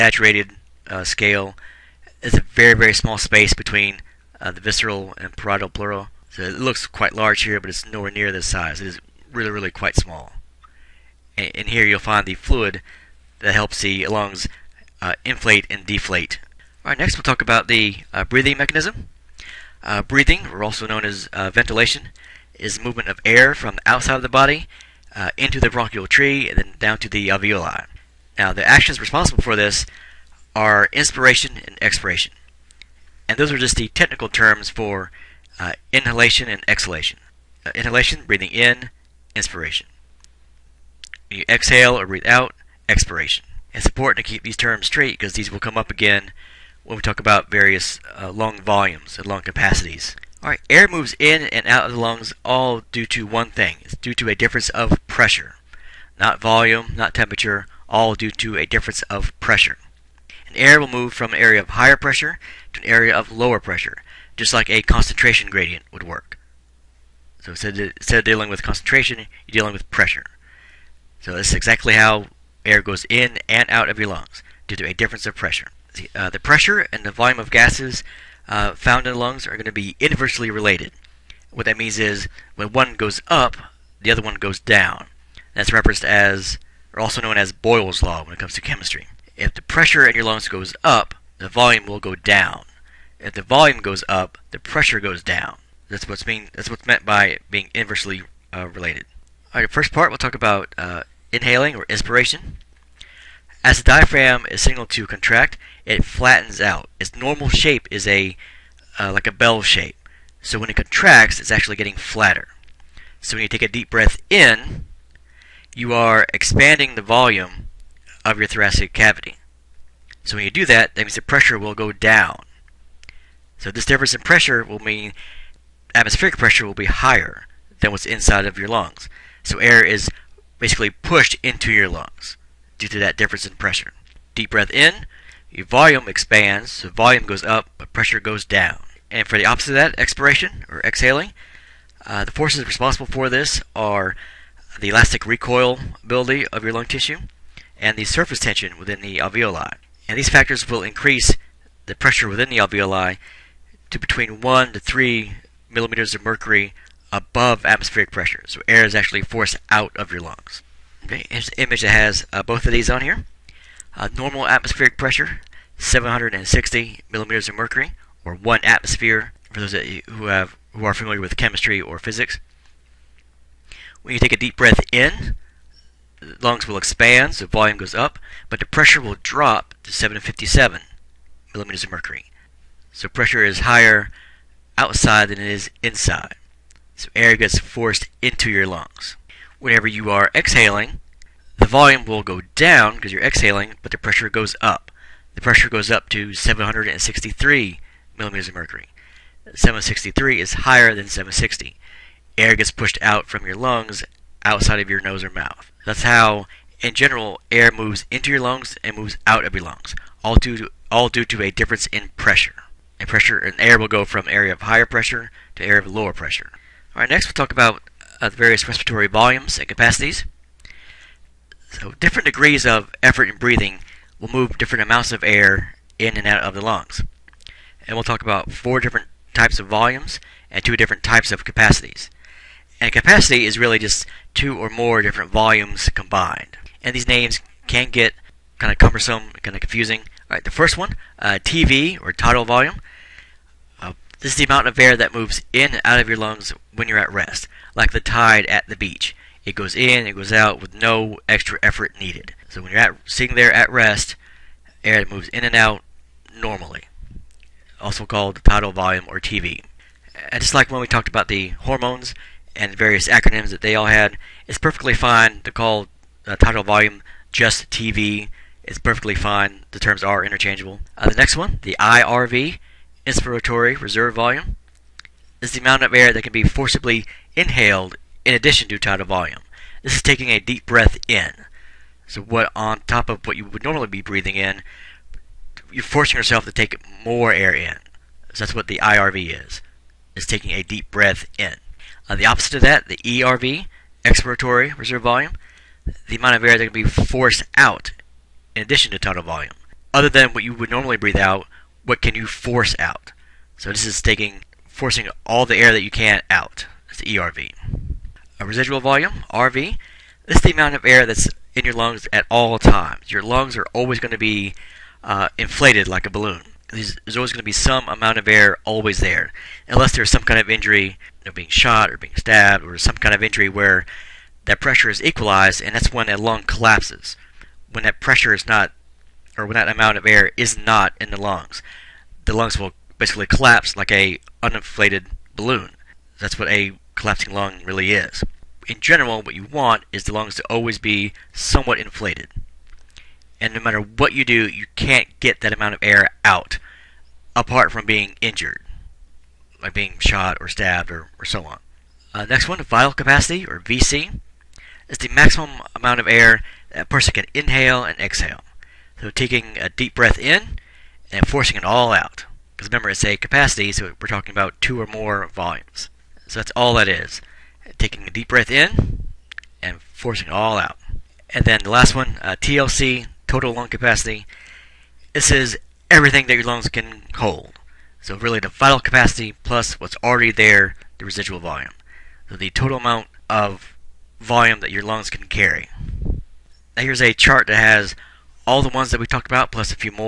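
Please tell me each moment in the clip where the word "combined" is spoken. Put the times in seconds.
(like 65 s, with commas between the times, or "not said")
235 s.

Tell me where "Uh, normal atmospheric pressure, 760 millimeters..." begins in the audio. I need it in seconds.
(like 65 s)
163 s.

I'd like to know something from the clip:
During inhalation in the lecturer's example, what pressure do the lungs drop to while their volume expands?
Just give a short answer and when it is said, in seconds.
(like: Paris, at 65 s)
757 mmHg, at 179 s.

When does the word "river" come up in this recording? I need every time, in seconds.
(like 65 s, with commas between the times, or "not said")
not said.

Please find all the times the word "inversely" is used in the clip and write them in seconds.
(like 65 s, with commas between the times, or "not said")
80 s, 97 s.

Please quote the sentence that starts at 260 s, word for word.
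And just like when we talked about the hormones, and various acronyms that they all had.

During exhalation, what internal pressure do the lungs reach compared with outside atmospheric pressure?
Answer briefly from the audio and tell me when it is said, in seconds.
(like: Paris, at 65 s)
763 mmHg, at 196 s.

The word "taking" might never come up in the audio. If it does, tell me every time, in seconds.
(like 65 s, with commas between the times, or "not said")
280 s, 290 s, 304 s, 359 s, 367 s.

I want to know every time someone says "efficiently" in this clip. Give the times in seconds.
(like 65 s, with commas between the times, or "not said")
not said.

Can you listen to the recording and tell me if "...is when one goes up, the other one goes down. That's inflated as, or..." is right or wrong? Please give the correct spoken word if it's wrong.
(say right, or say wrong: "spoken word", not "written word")
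wrong: "referenced", not "inflated".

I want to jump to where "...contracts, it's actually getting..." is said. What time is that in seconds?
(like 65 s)
110 s.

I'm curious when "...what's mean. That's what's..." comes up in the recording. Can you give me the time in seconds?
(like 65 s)
96 s.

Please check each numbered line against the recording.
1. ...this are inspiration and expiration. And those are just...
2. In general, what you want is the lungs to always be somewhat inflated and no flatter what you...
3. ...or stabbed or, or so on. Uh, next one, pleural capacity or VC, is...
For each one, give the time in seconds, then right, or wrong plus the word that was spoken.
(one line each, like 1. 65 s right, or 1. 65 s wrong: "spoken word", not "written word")
1. 29 s right
2. 338 s wrong: "matter", not "flatter"
3. 350 s wrong: "vital", not "pleural".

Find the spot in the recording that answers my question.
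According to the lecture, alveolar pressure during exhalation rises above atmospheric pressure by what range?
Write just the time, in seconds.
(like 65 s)
154 s.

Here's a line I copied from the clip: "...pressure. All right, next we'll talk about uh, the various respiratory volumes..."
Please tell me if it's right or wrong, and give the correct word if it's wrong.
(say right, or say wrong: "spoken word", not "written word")
right.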